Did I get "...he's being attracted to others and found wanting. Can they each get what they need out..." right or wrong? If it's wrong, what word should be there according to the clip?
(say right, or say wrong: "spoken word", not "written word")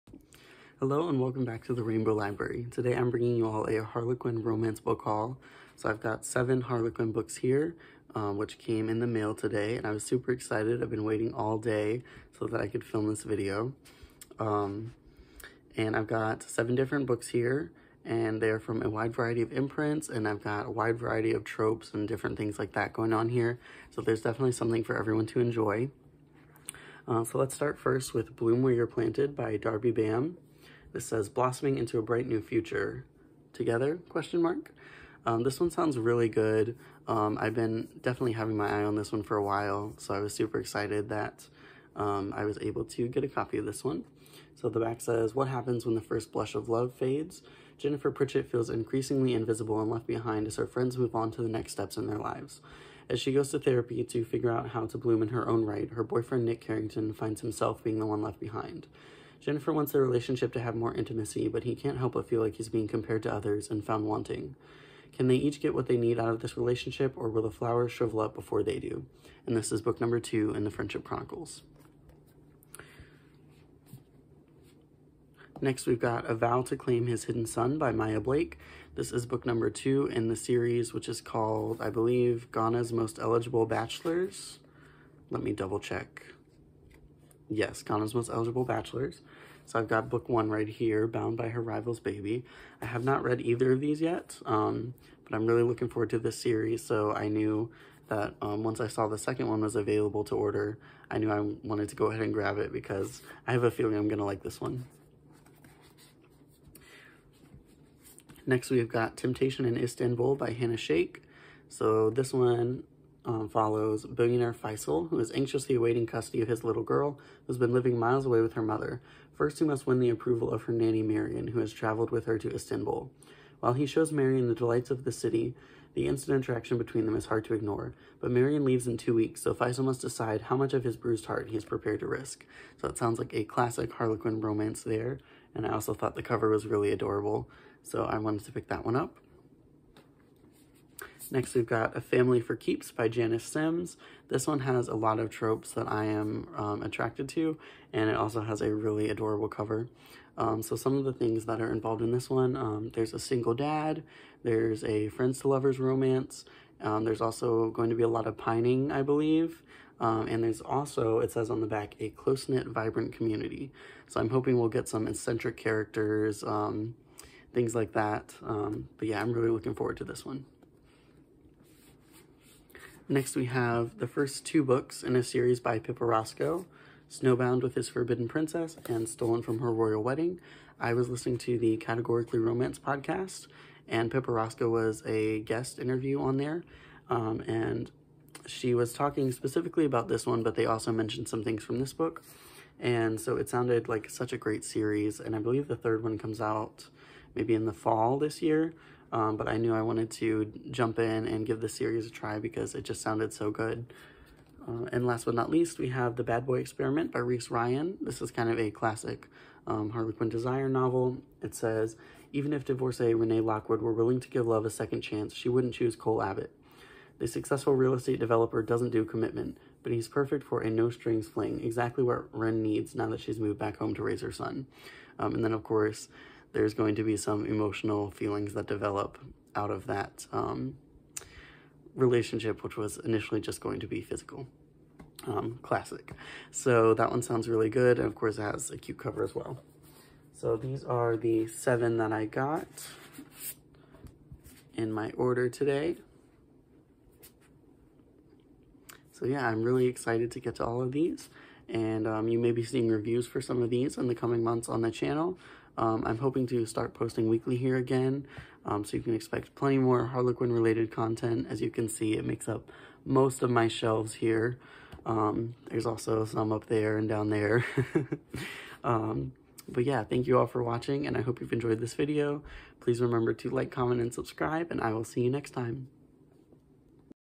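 wrong: "compared", not "attracted".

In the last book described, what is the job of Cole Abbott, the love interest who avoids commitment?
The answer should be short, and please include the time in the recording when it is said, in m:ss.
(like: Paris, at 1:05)
Real estate developer, at 3:37.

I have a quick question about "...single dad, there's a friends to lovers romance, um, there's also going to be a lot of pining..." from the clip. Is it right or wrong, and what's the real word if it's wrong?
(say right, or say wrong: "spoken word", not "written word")
right.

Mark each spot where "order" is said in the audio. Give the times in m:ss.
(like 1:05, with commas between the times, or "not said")
1:40, 4:05.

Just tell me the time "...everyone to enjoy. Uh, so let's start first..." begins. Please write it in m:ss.
0:24.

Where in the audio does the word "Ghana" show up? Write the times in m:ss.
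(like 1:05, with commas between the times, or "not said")
1:22, 1:27.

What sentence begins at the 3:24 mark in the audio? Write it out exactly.
Uh, and last but not least, we have The Bad Boy Experiment by Reese Ryan.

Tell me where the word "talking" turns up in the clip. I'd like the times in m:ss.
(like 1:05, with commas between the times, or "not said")
3:08.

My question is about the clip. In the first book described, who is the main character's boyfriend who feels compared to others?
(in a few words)
Nick Carrington.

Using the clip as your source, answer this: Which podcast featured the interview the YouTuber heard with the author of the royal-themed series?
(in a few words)
Categorically Romance.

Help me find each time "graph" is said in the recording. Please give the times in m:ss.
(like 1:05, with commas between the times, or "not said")
not said.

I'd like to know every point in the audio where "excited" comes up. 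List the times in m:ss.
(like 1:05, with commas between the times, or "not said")
0:10, 0:40, 4:09.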